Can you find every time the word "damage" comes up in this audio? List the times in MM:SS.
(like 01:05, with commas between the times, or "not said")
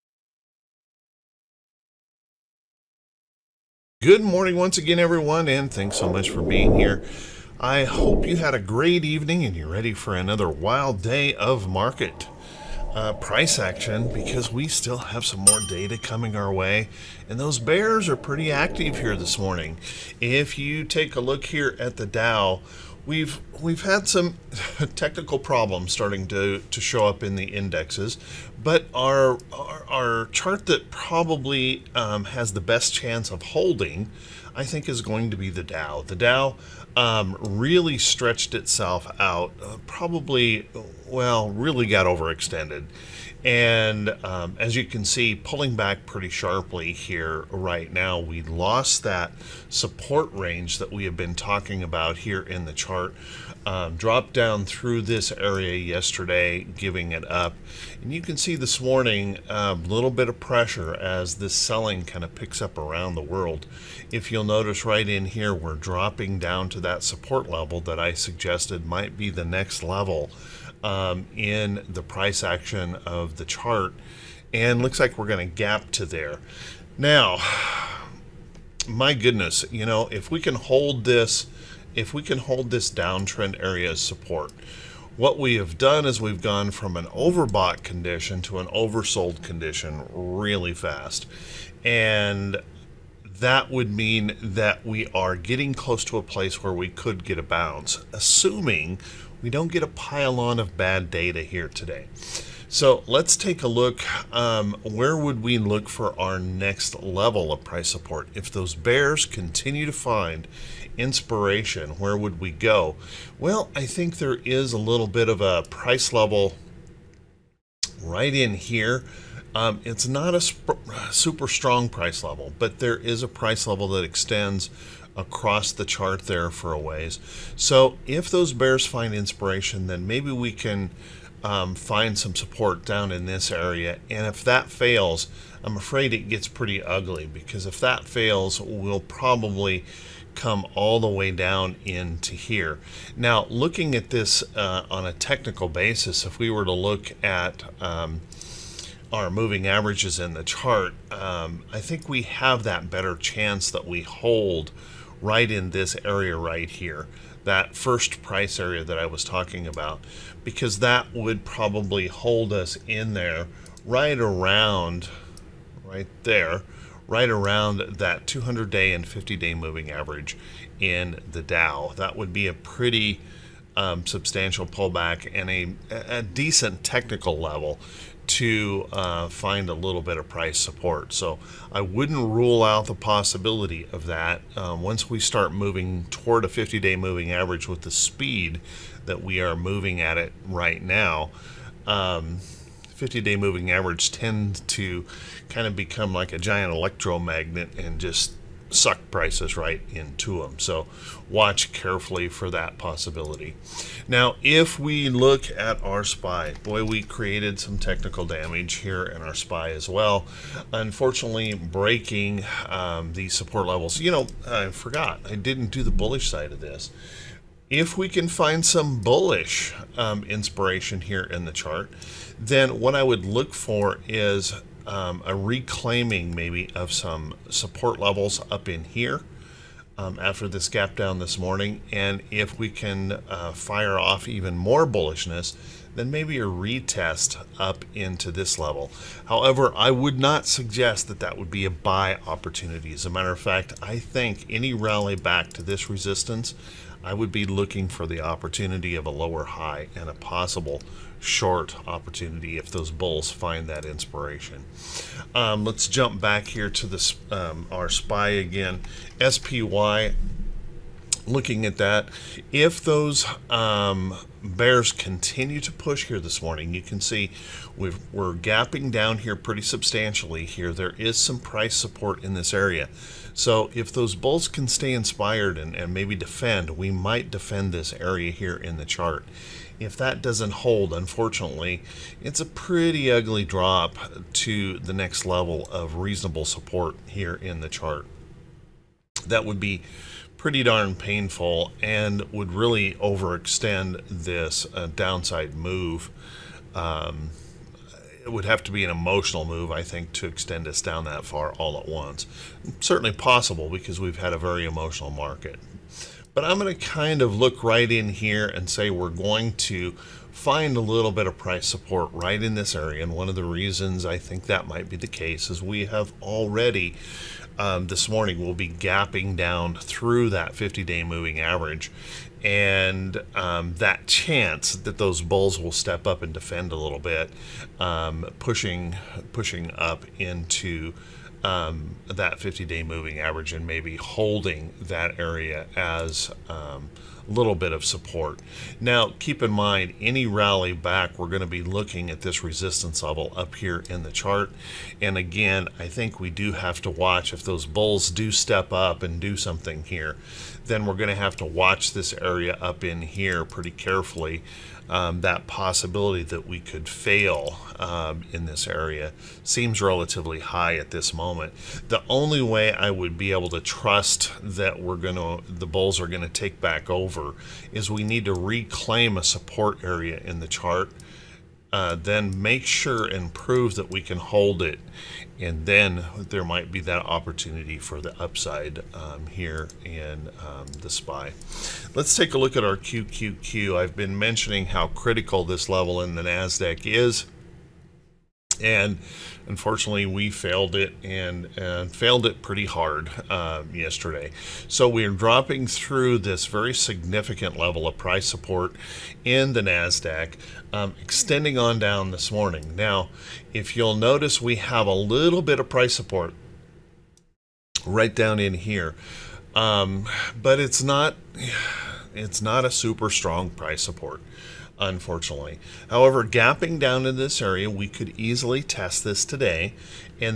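03:28.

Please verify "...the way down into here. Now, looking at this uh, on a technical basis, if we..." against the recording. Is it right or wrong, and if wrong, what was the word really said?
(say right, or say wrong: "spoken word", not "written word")
right.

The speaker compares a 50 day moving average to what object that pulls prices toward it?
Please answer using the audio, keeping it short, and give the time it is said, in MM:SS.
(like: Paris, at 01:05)
giant electromagnet, at 03:16.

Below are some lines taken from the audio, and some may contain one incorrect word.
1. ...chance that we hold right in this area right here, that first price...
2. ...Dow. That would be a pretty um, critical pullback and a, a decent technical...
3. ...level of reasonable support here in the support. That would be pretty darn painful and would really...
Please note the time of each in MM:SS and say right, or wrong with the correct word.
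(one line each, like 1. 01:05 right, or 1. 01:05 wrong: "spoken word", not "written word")
1. 02:33 right
2. 02:51 wrong: "substantial", not "critical"
3. 04:45 wrong: "chart", not "support".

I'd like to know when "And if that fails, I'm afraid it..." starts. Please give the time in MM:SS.
02:14.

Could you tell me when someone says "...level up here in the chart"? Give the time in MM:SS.
05:43.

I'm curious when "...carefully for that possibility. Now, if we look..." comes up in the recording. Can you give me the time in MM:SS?
03:21.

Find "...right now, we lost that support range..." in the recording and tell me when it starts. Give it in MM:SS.
00:47.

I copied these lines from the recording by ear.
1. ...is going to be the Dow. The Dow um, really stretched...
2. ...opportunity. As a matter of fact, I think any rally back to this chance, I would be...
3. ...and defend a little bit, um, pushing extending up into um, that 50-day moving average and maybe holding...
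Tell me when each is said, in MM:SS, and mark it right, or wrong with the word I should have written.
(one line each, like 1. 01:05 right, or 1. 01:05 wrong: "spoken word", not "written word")
1. 00:34 right
2. 04:02 wrong: "resistance", not "chance"
3. 05:26 wrong: "pushing", not "extending".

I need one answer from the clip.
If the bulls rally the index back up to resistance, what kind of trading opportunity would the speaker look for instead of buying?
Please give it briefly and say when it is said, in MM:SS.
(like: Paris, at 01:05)
short opportunity, at 04:11.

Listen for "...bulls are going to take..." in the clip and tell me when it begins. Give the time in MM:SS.
06:05.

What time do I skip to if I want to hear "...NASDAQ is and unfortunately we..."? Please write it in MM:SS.
06:26.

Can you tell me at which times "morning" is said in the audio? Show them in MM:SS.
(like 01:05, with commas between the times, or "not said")
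00:04, 00:19, 00:58, 03:51, 04:26, 05:18, 06:42.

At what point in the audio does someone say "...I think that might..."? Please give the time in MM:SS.
05:14.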